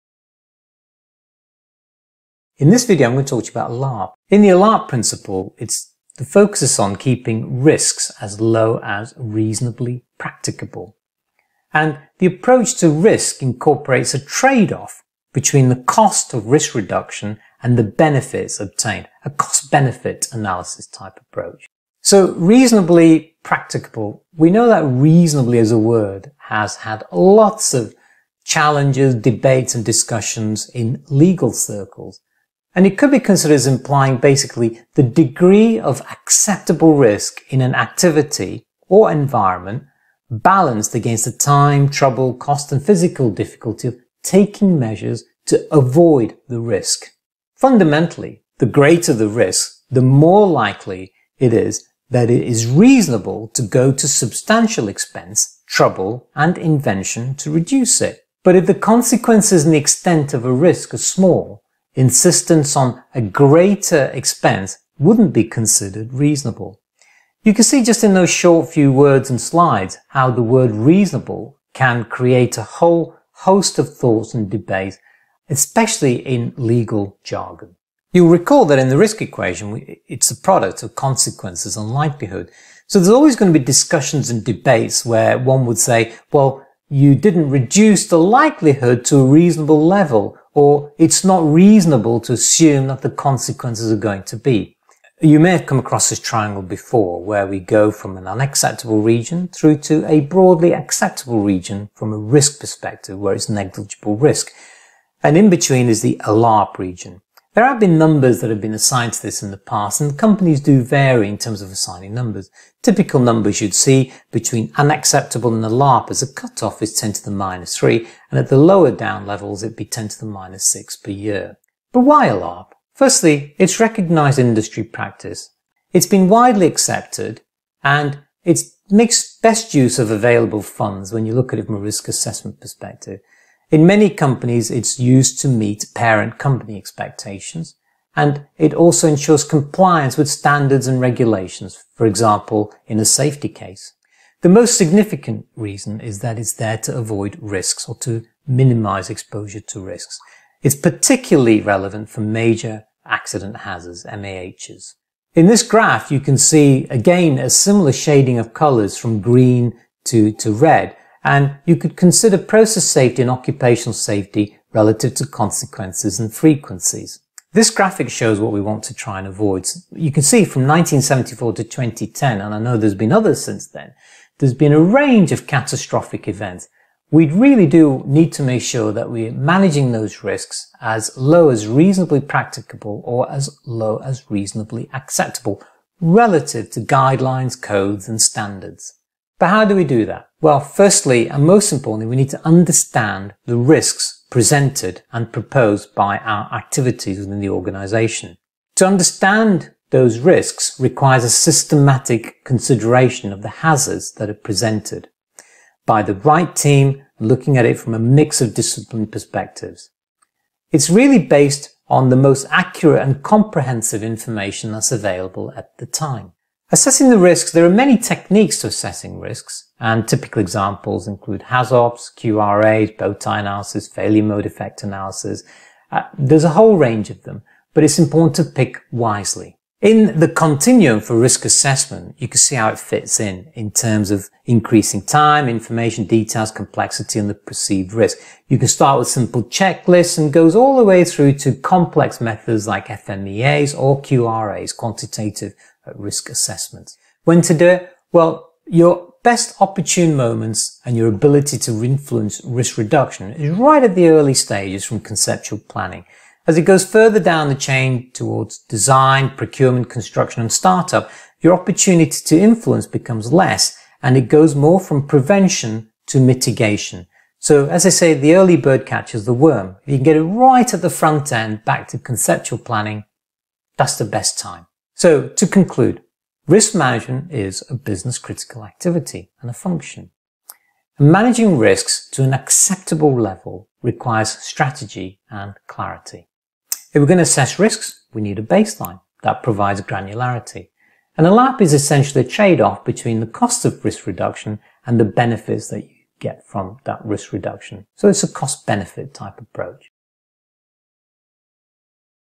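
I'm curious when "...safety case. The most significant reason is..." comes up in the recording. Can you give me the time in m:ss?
2:23.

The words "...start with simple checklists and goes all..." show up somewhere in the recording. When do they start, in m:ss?
3:58.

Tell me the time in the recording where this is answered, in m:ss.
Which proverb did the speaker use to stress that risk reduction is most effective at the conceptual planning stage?
4:28.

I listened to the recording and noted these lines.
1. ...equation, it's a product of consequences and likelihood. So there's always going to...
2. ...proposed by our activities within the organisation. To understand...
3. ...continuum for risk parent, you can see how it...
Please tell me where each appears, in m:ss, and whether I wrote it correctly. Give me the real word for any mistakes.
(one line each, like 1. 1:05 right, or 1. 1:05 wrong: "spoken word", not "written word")
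1. 1:19 right
2. 3:15 right
3. 3:50 wrong: "assessment", not "parent".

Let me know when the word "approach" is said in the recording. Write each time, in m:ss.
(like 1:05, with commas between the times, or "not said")
0:12, 0:21, 4:59.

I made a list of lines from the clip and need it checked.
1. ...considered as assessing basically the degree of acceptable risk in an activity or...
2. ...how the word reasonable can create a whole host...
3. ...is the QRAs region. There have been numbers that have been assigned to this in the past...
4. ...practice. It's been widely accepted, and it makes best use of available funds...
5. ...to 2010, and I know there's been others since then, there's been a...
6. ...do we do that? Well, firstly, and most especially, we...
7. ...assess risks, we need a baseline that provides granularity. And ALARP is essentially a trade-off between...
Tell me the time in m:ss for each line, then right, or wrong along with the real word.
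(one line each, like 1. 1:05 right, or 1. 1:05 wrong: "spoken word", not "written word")
1. 0:33 wrong: "implying", not "assessing"
2. 1:10 right
3. 1:45 wrong: "ALARP", not "QRAs"
4. 2:04 right
5. 2:51 right
6. 3:09 wrong: "importantly", not "especially"
7. 4:47 right.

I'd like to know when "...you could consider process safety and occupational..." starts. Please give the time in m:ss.
2:41.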